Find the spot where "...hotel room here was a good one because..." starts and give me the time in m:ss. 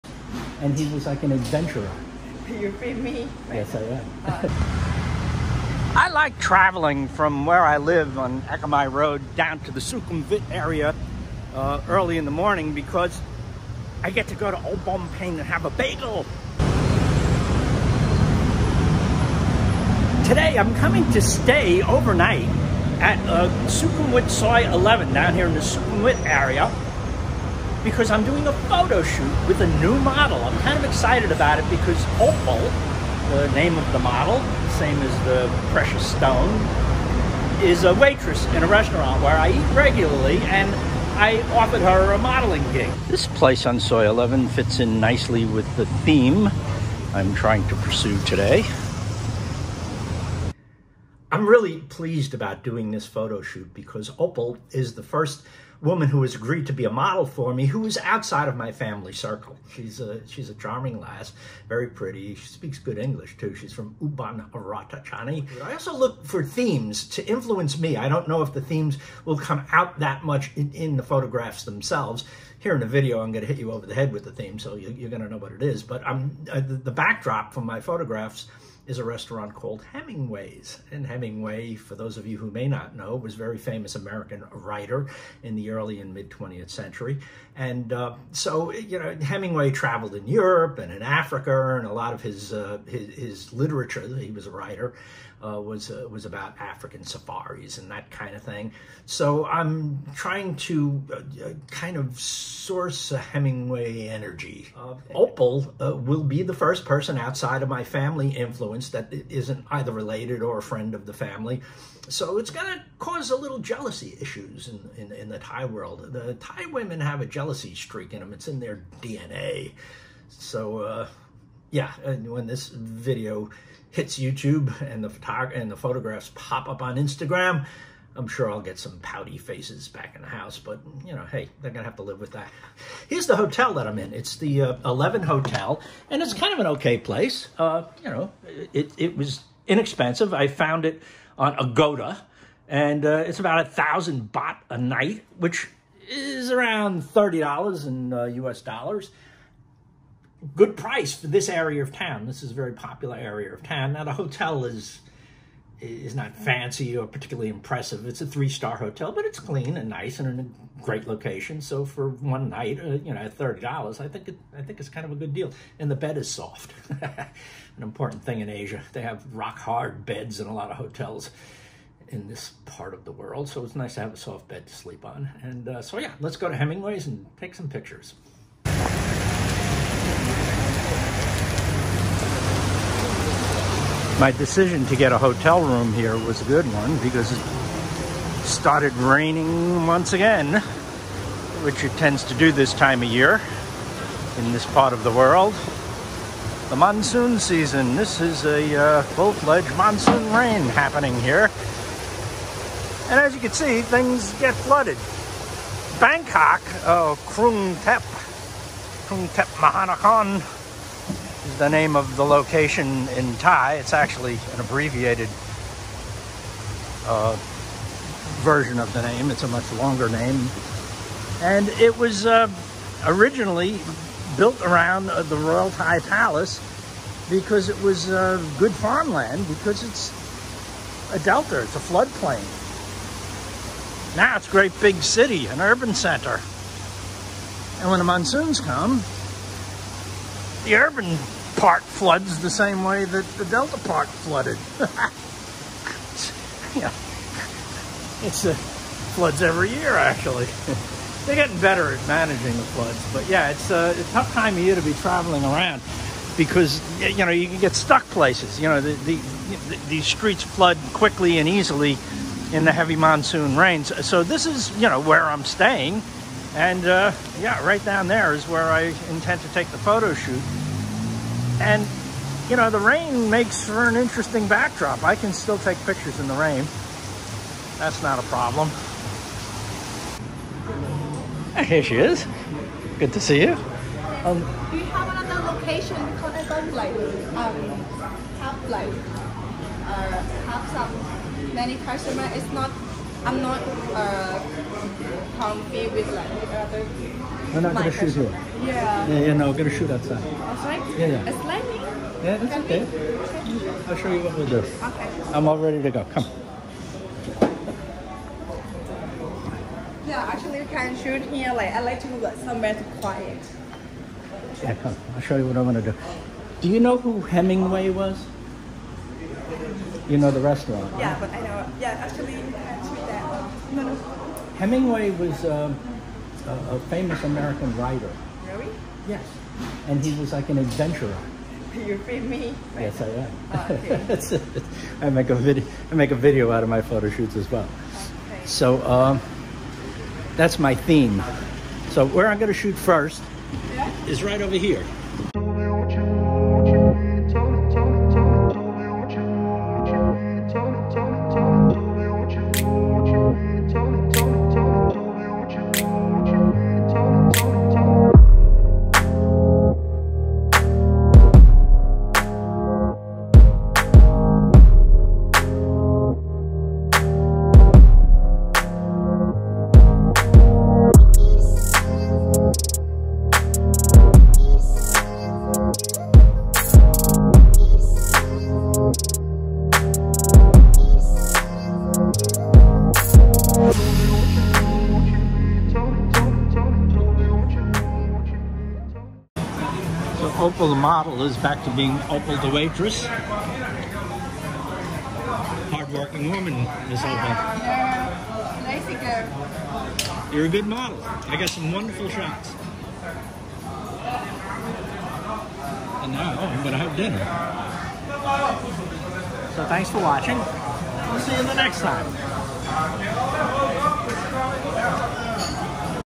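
3:05.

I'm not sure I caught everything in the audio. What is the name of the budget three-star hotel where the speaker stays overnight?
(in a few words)
Eleven Hotel.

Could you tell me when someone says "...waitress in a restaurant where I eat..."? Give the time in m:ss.
0:37.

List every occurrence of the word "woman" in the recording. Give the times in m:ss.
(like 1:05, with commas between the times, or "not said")
0:55, 6:36.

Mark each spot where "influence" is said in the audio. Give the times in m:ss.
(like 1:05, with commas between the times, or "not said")
1:07, 1:48.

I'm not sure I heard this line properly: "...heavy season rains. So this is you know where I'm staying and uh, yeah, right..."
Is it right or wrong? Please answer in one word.
wrong.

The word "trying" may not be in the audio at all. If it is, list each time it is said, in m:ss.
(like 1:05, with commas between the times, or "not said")
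0:47, 1:40.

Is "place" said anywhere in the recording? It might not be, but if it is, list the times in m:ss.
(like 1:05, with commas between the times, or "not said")
0:43, 2:16, 4:18.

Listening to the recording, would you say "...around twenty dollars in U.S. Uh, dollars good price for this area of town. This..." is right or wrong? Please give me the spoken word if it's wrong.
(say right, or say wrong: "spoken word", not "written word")
wrong: "thirty", not "twenty".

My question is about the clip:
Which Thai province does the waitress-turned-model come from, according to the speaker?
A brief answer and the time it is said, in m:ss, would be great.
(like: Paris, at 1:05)
Ubon Ratchathani, at 1:04.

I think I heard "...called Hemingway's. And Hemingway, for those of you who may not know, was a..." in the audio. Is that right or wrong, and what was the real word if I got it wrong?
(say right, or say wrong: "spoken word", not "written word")
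right.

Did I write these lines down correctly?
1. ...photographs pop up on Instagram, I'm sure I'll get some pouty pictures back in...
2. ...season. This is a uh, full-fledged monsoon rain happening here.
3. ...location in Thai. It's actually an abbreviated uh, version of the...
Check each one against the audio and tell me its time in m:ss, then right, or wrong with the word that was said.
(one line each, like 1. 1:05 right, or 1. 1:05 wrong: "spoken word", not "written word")
1. 2:05 wrong: "faces", not "pictures"
2. 3:17 right
3. 3:32 right.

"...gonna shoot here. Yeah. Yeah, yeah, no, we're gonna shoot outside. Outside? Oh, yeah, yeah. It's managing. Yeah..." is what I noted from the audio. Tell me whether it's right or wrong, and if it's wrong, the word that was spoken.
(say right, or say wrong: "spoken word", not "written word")
wrong: "lightning", not "managing".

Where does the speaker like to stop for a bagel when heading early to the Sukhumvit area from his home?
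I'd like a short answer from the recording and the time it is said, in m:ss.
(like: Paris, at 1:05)
Old Bombay, at 0:14.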